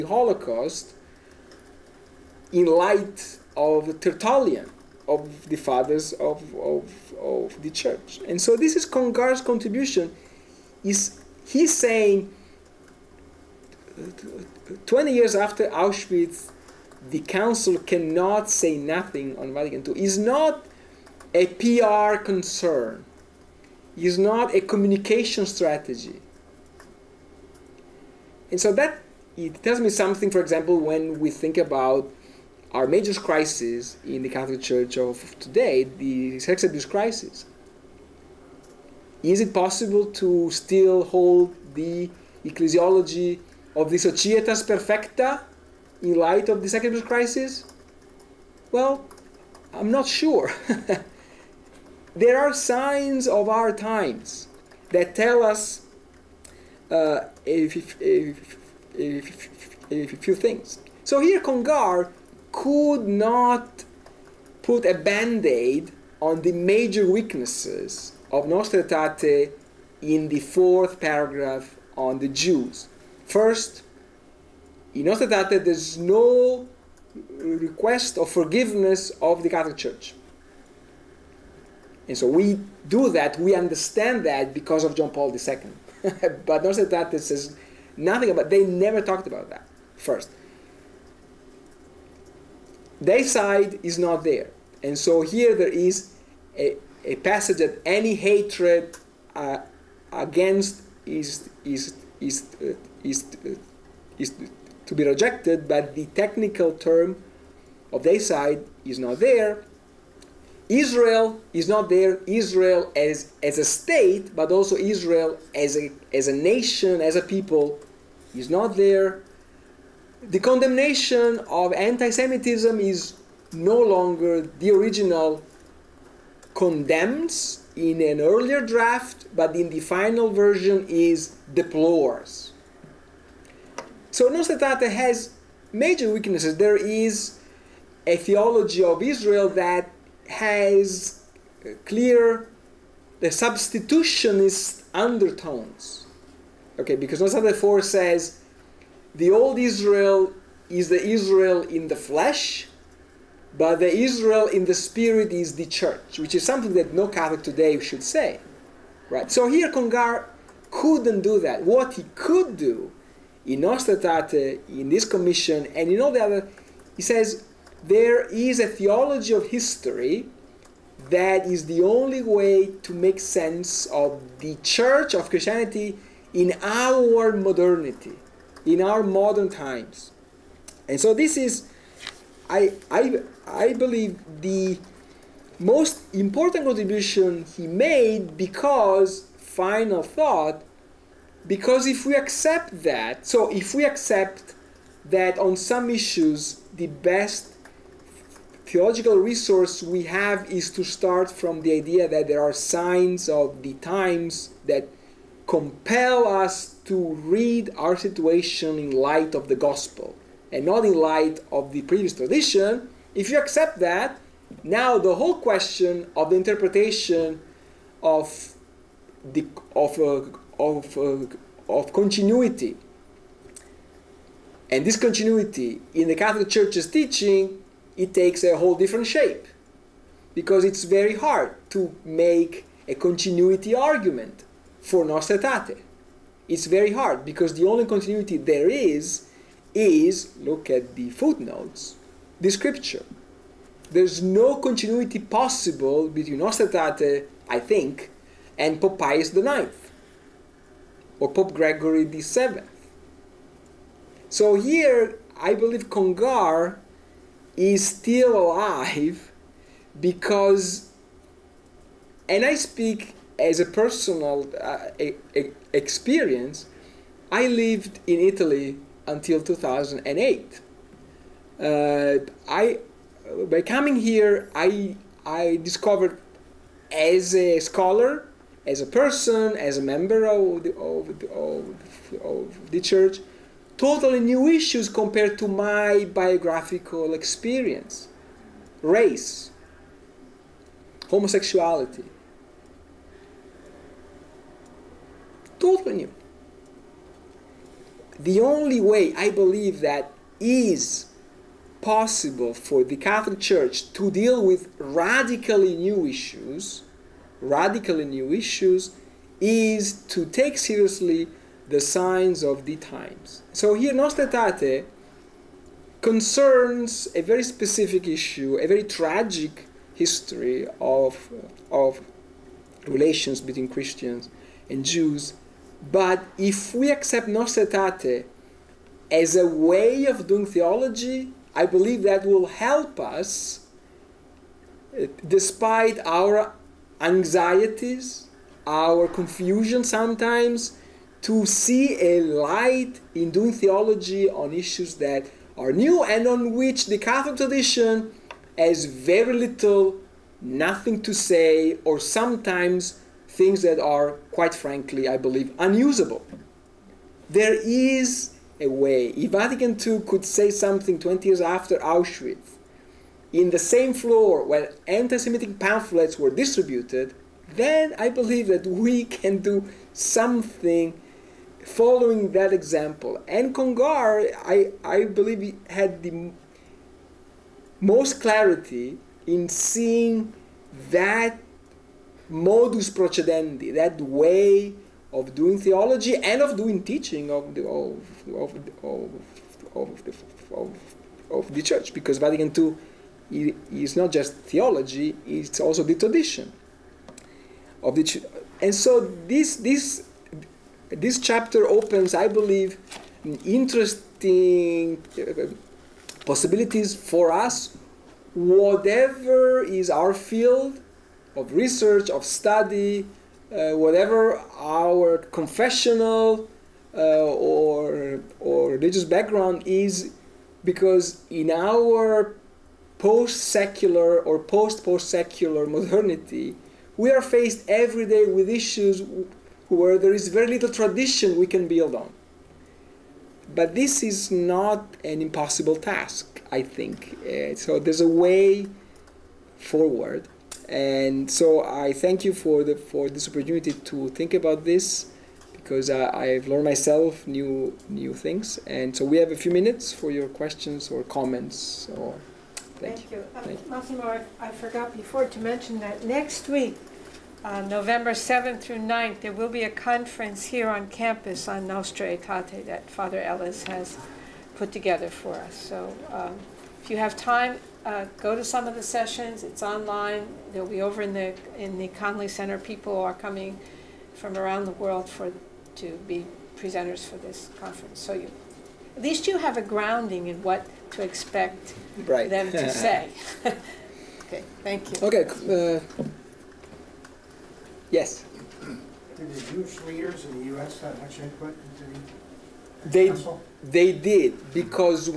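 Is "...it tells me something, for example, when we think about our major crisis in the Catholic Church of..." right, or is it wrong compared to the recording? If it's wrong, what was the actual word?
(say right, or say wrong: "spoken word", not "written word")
right.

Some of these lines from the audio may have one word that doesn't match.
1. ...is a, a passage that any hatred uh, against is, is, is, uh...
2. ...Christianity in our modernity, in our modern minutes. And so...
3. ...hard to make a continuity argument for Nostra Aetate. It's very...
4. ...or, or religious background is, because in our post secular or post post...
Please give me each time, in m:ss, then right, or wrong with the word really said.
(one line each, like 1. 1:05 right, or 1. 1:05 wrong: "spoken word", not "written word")
1. 1:35 right
2. 2:55 wrong: "times", not "minutes"
3. 3:51 right
4. 6:57 right.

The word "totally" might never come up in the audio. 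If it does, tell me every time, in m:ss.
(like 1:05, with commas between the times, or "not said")
4:43, 4:55.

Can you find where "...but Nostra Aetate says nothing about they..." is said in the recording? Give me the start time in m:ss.
1:26.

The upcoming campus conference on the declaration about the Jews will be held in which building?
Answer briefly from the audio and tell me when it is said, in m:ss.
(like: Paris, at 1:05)
Conley Center, at 7:51.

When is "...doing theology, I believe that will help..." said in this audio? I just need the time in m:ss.
5:30.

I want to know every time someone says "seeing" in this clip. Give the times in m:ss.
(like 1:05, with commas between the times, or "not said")
6:19.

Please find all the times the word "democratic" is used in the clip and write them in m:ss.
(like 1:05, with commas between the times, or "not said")
not said.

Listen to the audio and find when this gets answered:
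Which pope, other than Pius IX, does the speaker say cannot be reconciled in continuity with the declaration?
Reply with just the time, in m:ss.
4:11.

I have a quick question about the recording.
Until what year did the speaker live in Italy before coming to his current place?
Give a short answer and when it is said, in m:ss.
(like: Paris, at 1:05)
2008, at 4:29.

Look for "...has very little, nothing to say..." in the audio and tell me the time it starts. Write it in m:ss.
5:48.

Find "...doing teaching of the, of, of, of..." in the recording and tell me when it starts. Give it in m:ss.
6:26.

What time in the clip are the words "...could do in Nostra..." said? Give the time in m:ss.
2:42.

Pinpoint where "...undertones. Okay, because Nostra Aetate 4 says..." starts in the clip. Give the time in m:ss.
2:24.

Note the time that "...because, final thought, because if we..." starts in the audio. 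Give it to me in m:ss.
3:08.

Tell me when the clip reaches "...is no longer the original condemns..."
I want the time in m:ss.
2:02.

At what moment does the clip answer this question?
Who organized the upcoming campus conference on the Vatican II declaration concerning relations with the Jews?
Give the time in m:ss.
7:42.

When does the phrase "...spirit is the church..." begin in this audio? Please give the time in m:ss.
2:34.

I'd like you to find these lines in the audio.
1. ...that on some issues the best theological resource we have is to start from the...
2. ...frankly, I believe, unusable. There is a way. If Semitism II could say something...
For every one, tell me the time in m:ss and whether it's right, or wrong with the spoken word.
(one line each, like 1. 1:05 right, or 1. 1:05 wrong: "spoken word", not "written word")
1. 3:15 right
2. 5:54 wrong: "Vatican", not "Semitism".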